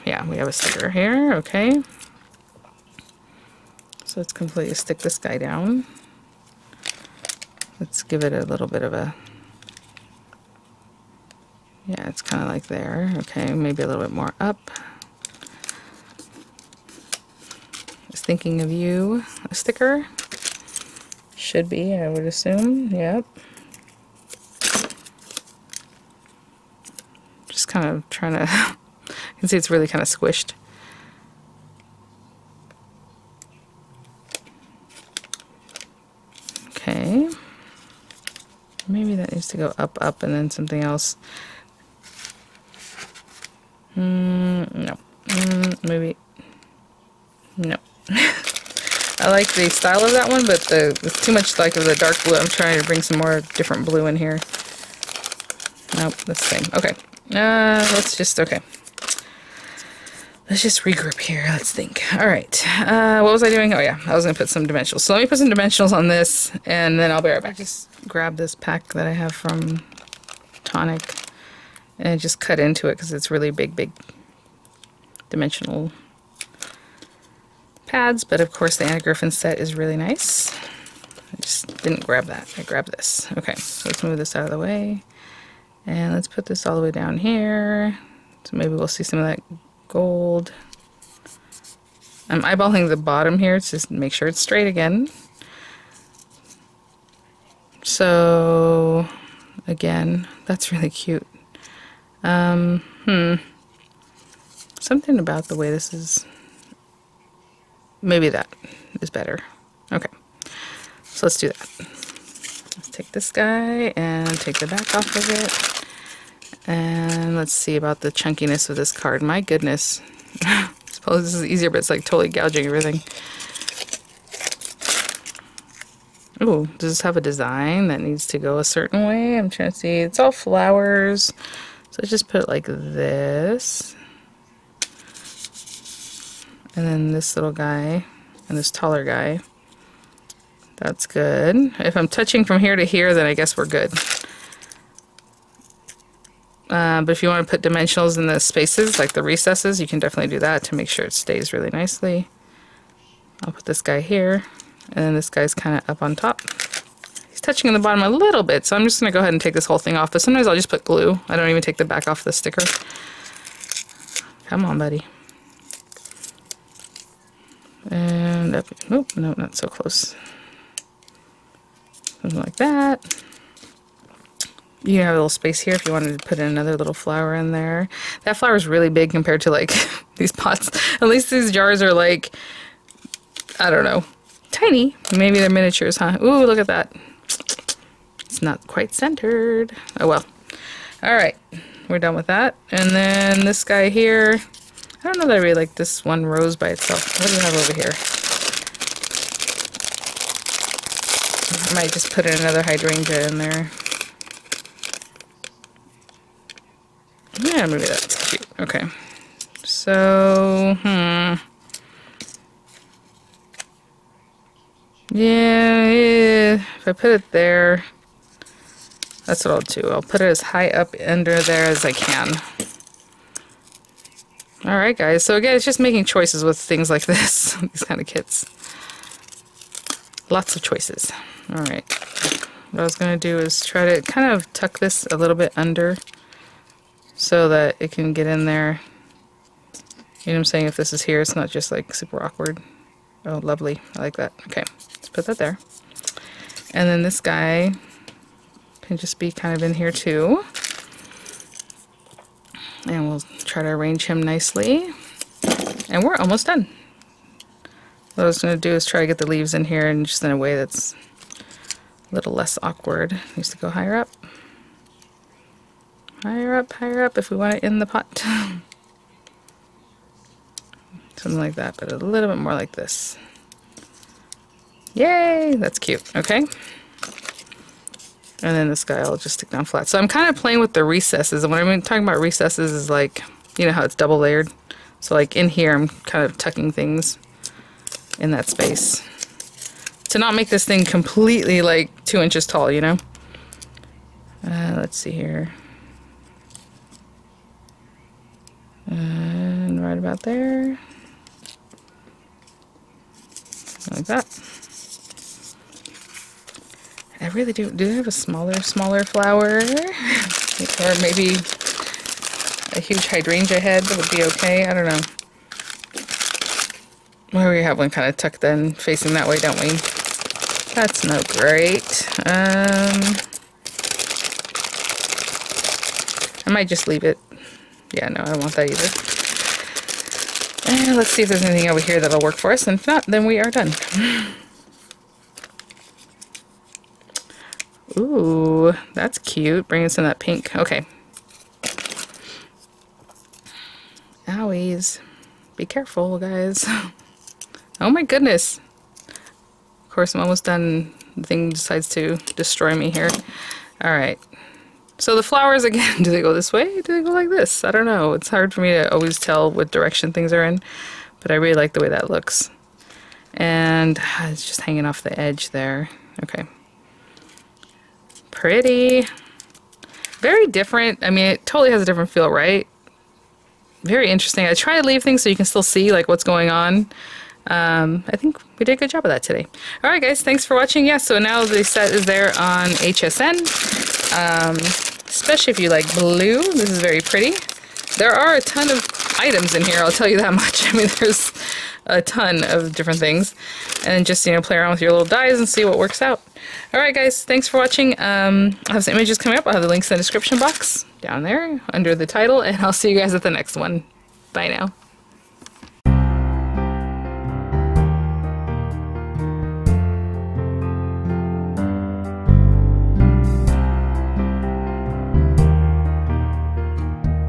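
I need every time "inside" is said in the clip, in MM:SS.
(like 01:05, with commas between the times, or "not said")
not said.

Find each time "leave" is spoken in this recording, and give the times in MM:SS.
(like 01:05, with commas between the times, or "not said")
04:19, 05:26, 06:14.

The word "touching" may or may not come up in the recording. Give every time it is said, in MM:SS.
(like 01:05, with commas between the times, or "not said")
02:22, 02:37.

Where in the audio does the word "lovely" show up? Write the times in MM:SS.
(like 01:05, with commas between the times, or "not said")
04:03.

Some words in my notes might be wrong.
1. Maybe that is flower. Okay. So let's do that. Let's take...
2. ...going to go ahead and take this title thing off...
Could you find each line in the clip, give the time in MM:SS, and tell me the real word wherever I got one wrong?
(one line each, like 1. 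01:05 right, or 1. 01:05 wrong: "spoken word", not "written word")
1. 01:48 wrong: "better", not "flower"
2. 02:38 wrong: "whole", not "title".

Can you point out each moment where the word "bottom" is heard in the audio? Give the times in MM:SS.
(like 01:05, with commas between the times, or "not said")
01:32, 02:37.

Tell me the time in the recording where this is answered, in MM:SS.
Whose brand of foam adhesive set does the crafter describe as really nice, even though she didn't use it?
01:18.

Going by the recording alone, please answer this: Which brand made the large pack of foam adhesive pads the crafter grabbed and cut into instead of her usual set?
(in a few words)
Tonic.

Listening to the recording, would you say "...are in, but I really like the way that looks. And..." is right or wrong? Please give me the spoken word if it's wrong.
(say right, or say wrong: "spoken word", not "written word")
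right.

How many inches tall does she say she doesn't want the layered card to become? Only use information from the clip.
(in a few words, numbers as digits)
2 inches.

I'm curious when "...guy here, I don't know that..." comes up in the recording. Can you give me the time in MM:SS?
03:13.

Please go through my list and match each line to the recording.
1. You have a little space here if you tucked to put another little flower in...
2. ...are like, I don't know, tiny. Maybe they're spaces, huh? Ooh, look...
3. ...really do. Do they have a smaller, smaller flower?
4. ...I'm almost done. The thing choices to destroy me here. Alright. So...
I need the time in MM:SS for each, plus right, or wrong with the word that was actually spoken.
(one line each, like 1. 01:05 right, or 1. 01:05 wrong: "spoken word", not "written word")
1. 02:54 wrong: "wanted", not "tucked"
2. 03:01 wrong: "miniatures", not "spaces"
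3. 05:07 right
4. 05:50 wrong: "decides", not "choices".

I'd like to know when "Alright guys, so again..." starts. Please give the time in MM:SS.
03:44.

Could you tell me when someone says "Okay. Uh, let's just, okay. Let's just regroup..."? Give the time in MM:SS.
00:56.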